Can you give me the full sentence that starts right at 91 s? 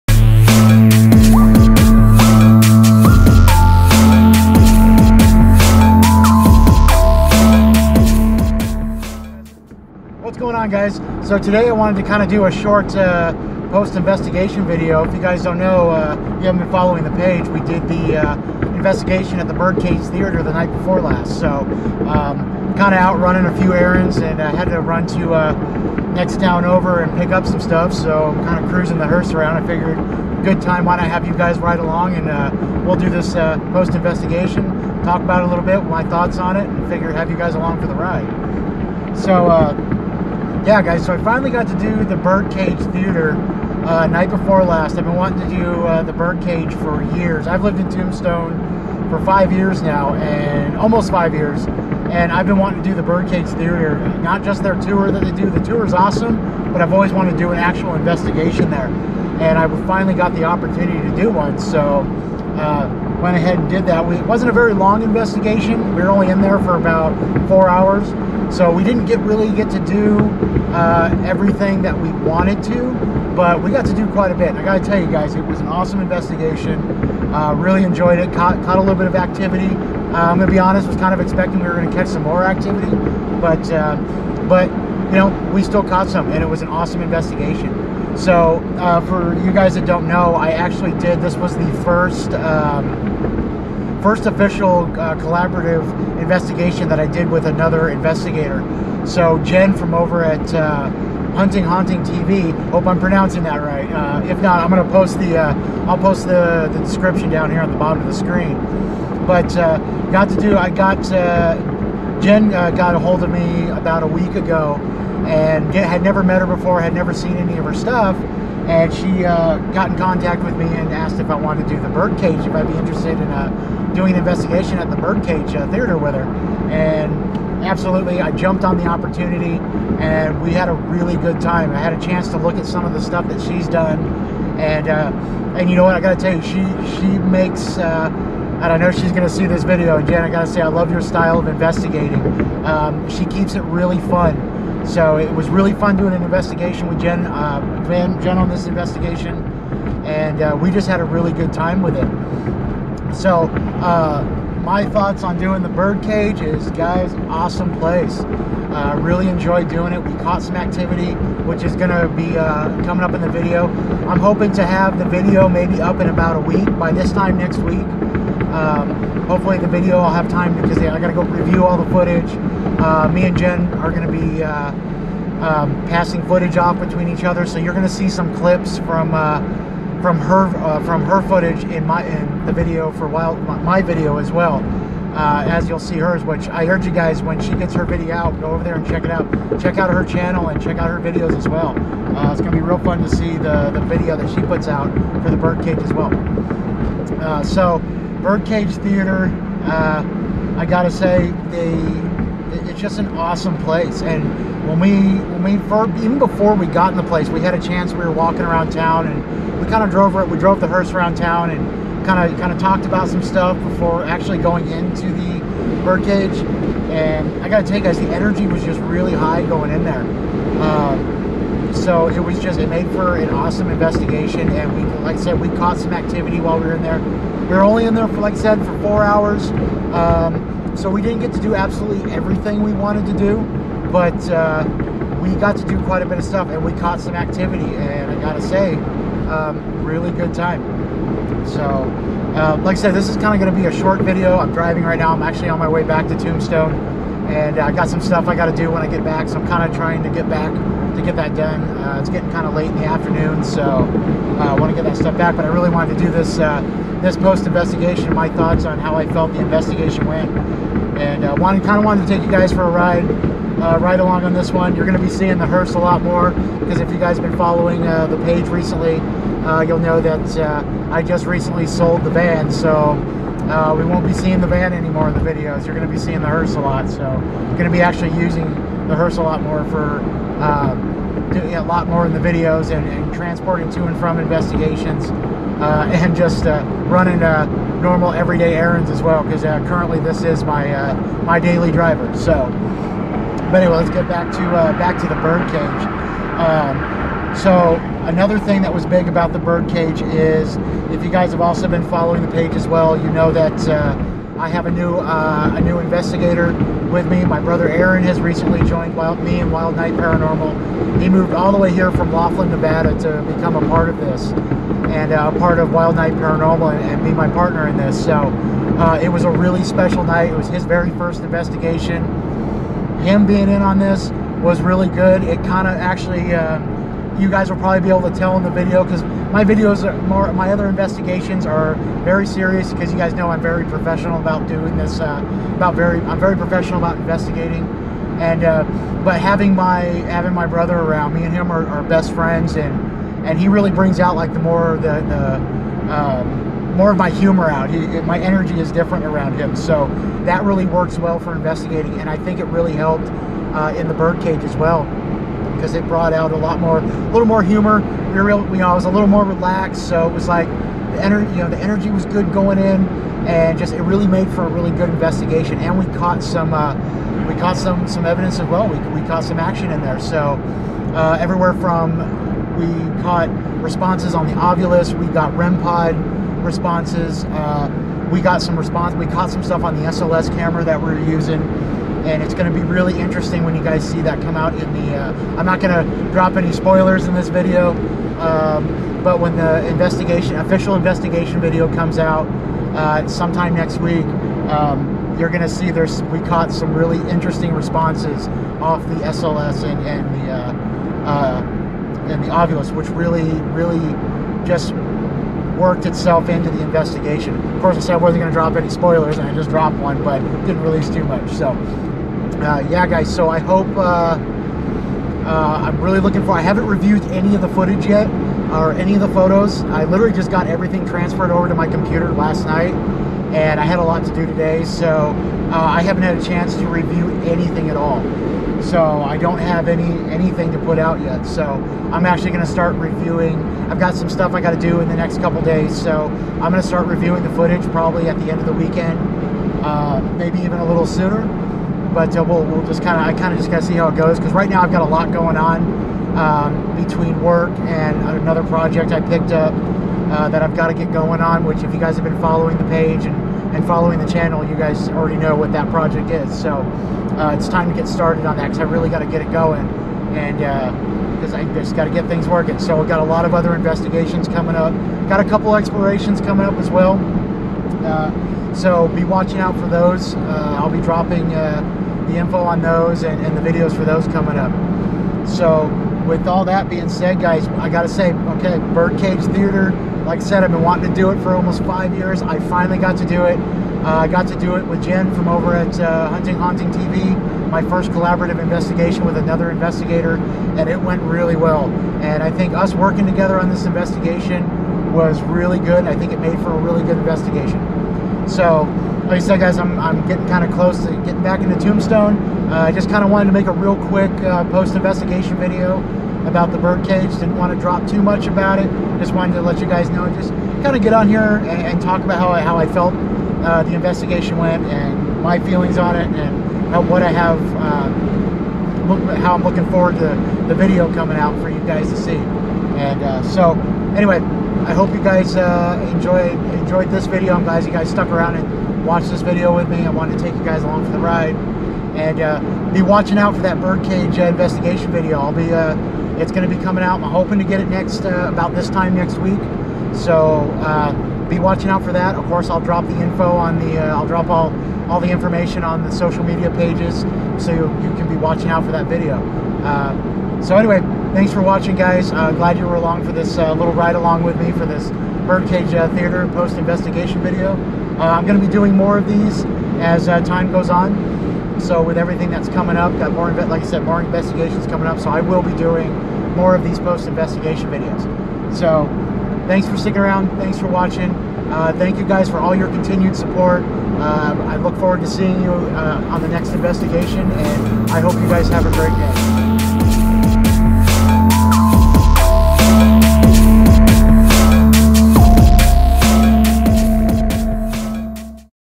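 This was the first um, first official uh, collaborative investigation that I did with another investigator.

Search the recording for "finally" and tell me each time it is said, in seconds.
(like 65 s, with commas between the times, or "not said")
41 s, 59 s, 482 s.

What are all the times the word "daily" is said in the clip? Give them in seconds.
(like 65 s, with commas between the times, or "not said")
291 s.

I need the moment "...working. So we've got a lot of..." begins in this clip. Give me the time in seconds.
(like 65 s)
462 s.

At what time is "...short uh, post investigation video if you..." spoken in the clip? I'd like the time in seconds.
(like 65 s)
12 s.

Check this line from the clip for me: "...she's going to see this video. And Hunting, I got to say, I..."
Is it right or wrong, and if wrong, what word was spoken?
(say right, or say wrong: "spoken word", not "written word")
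wrong: "Jen", not "Hunting".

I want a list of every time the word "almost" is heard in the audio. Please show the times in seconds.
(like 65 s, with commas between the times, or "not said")
50 s, 481 s.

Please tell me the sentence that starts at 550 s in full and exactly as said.
so anyway, thanks for watching, guys.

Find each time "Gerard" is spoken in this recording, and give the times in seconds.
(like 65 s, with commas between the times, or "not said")
not said.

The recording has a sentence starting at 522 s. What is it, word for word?
And uh, so, anyway, I hope you guys uh, enjoyed enjoyed this video.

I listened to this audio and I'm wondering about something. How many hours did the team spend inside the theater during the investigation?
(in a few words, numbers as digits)
4.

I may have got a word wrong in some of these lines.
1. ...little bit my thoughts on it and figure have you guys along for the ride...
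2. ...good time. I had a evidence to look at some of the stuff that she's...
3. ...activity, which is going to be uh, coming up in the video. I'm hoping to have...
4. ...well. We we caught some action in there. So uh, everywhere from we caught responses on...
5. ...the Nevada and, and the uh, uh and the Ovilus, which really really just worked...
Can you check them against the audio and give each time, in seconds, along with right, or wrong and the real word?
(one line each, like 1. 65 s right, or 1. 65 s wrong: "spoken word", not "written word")
1. 35 s right
2. 131 s wrong: "chance", not "evidence"
3. 160 s right
4. 368 s right
5. 398 s wrong: "SLS", not "Nevada".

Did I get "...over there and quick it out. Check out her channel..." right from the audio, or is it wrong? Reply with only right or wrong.
wrong.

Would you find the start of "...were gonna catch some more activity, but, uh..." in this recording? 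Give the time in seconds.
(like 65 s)
81 s.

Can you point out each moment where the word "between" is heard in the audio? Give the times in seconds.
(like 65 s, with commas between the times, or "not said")
176 s, 446 s.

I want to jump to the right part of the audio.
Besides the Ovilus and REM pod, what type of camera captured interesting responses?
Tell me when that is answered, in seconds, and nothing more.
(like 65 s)
379 s.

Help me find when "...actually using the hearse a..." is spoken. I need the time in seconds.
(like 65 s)
277 s.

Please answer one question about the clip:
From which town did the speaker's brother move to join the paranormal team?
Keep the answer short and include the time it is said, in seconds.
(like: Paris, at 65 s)
Laughlin, Nevada, at 312 s.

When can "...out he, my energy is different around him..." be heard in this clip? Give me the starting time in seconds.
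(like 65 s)
347 s.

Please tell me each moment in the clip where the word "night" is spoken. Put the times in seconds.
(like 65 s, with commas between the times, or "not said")
20 s, 44 s, 309 s, 315 s, 320 s, 422 s.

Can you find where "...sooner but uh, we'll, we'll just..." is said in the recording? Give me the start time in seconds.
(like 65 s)
440 s.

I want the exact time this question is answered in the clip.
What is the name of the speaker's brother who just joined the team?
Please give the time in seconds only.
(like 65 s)
307 s.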